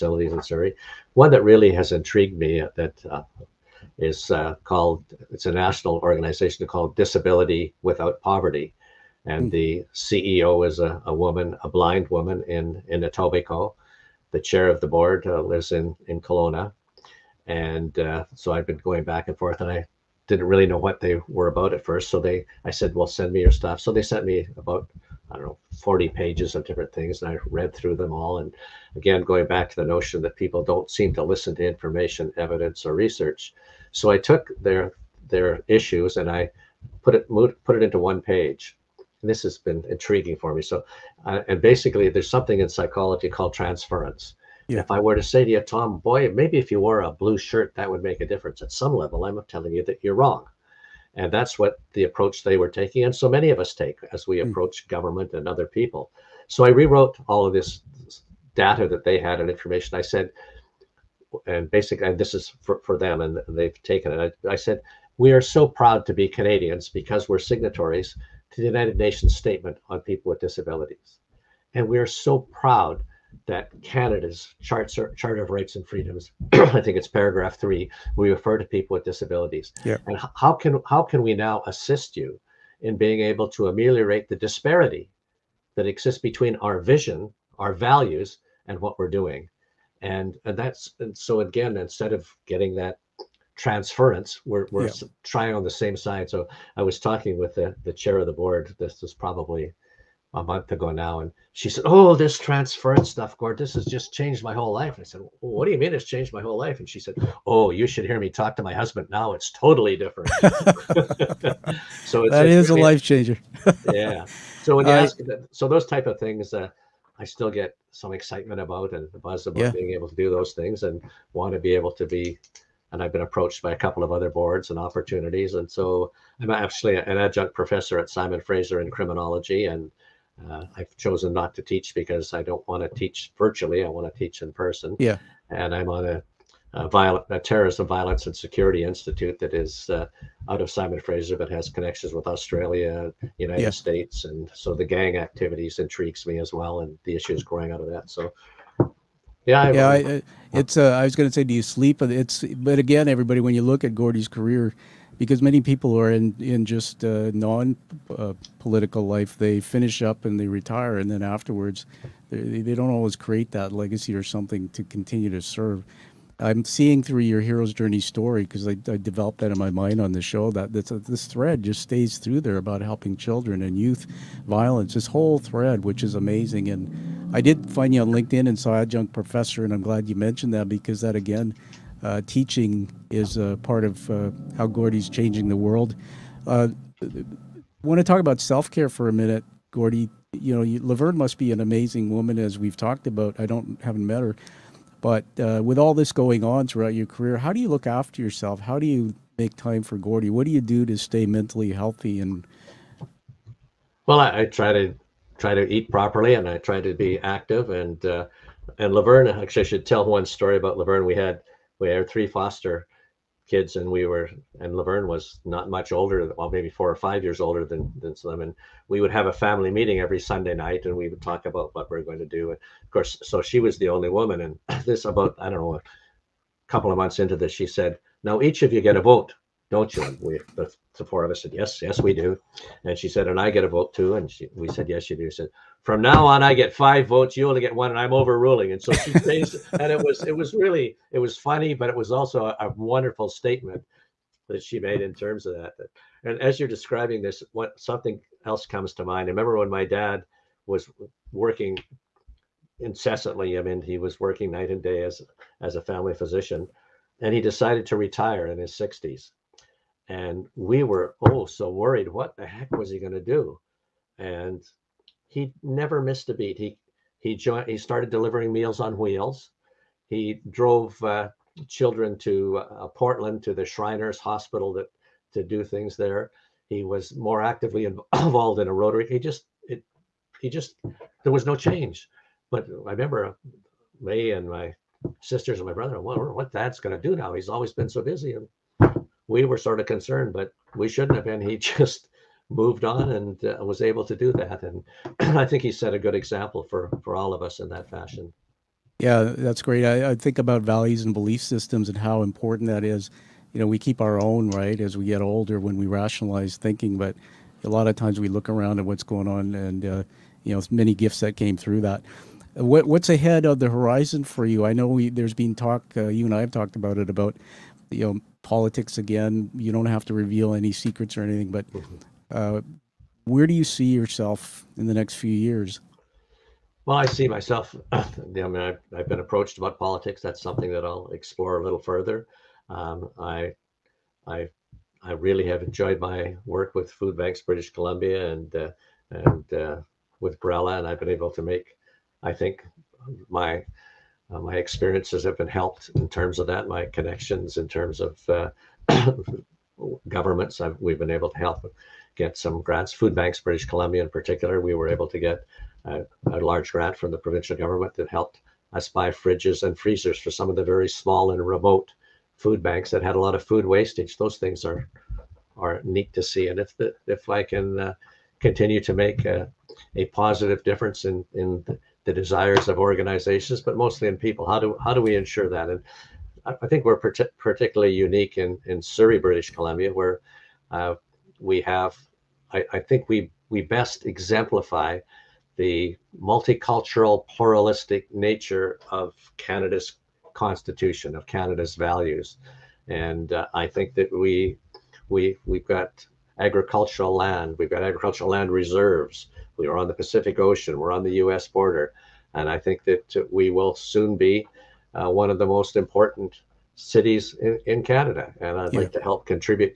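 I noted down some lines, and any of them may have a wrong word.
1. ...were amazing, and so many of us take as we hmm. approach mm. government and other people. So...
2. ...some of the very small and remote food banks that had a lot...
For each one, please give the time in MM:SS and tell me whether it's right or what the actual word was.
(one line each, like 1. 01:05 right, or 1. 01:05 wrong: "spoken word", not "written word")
1. 00:52 wrong: "taking", not "amazing"
2. 06:00 right.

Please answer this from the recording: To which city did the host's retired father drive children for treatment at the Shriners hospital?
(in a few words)
Portland.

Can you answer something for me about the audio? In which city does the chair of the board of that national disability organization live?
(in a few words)
Kelowna.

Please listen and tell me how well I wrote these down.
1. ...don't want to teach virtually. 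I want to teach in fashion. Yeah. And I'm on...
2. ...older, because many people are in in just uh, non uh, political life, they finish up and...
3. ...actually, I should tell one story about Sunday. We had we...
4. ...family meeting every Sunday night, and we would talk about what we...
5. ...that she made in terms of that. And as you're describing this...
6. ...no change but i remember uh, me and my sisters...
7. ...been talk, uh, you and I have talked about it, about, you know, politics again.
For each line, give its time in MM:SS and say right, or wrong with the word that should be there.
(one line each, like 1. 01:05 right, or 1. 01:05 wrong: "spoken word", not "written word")
1. 02:12 wrong: "person", not "fashion"
2. 02:34 wrong: "career", not "older"
3. 03:29 wrong: "Laverne", not "Sunday"
4. 03:39 right
5. 04:04 right
6. 04:41 right
7. 05:15 right.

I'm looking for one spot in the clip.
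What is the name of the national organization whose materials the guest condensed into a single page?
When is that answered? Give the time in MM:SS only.
00:06.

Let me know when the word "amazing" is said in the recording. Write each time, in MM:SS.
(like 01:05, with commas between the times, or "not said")
02:56, 03:11.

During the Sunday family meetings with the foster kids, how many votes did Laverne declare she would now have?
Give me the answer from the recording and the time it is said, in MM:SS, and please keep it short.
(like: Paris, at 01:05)
5, at 03:56.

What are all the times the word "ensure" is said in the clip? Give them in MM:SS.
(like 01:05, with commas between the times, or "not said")
06:15.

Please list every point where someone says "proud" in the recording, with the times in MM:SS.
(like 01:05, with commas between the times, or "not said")
01:05, 01:12.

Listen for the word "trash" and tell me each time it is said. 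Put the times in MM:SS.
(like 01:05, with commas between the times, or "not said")
not said.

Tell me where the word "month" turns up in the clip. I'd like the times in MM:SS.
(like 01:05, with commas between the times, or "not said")
01:40, 03:46.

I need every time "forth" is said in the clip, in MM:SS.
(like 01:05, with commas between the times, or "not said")
00:19.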